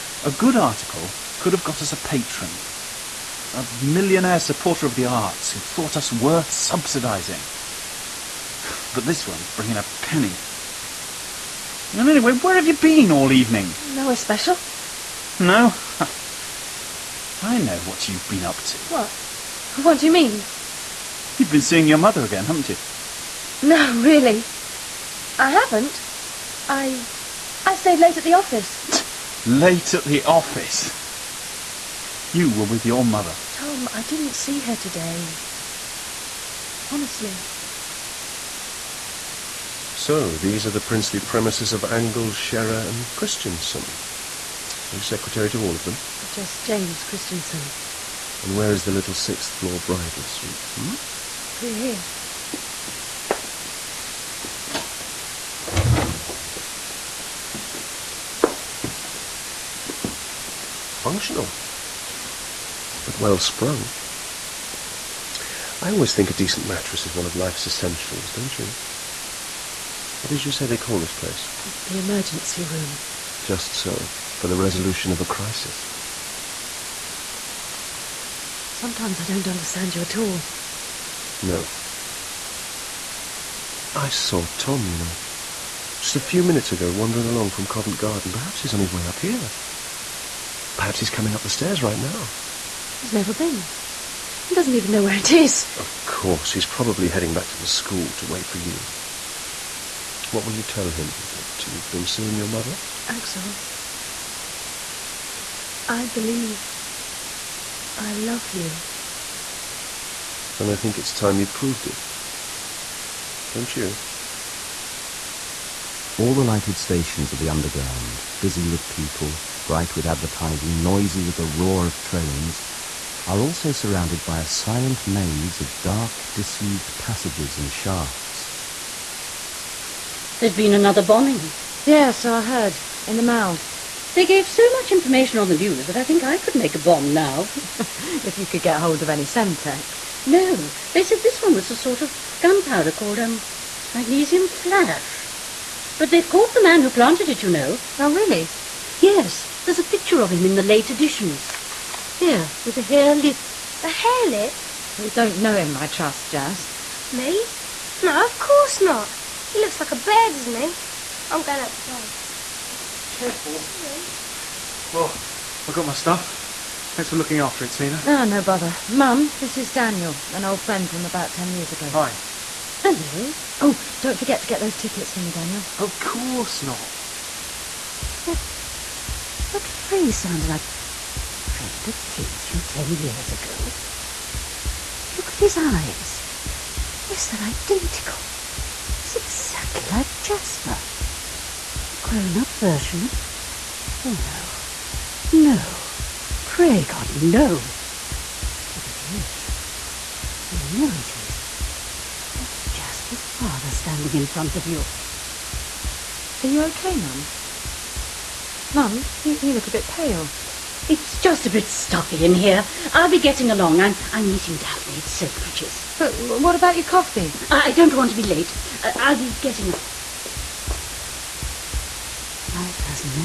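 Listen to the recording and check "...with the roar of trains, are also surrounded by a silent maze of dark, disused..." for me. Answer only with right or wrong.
right.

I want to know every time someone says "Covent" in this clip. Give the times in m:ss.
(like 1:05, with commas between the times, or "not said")
1:27.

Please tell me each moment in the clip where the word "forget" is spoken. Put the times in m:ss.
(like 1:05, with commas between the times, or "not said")
2:54.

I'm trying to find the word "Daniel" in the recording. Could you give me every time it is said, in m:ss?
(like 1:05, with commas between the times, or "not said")
2:49, 2:55.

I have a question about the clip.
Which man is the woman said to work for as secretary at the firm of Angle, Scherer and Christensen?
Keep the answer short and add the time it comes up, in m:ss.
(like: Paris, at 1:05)
James Christensen, at 0:46.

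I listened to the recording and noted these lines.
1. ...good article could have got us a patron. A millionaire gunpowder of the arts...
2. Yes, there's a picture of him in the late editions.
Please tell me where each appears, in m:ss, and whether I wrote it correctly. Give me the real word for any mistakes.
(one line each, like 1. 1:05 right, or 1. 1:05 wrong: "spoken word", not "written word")
1. 0:00 wrong: "supporter", not "gunpowder"
2. 2:29 right.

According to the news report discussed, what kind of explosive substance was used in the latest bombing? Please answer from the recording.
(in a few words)
Magnesium flash.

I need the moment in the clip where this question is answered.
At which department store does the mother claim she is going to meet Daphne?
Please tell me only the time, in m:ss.
3:35.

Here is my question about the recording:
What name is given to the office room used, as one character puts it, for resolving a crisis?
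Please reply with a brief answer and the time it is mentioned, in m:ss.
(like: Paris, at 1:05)
The emergency room, at 1:11.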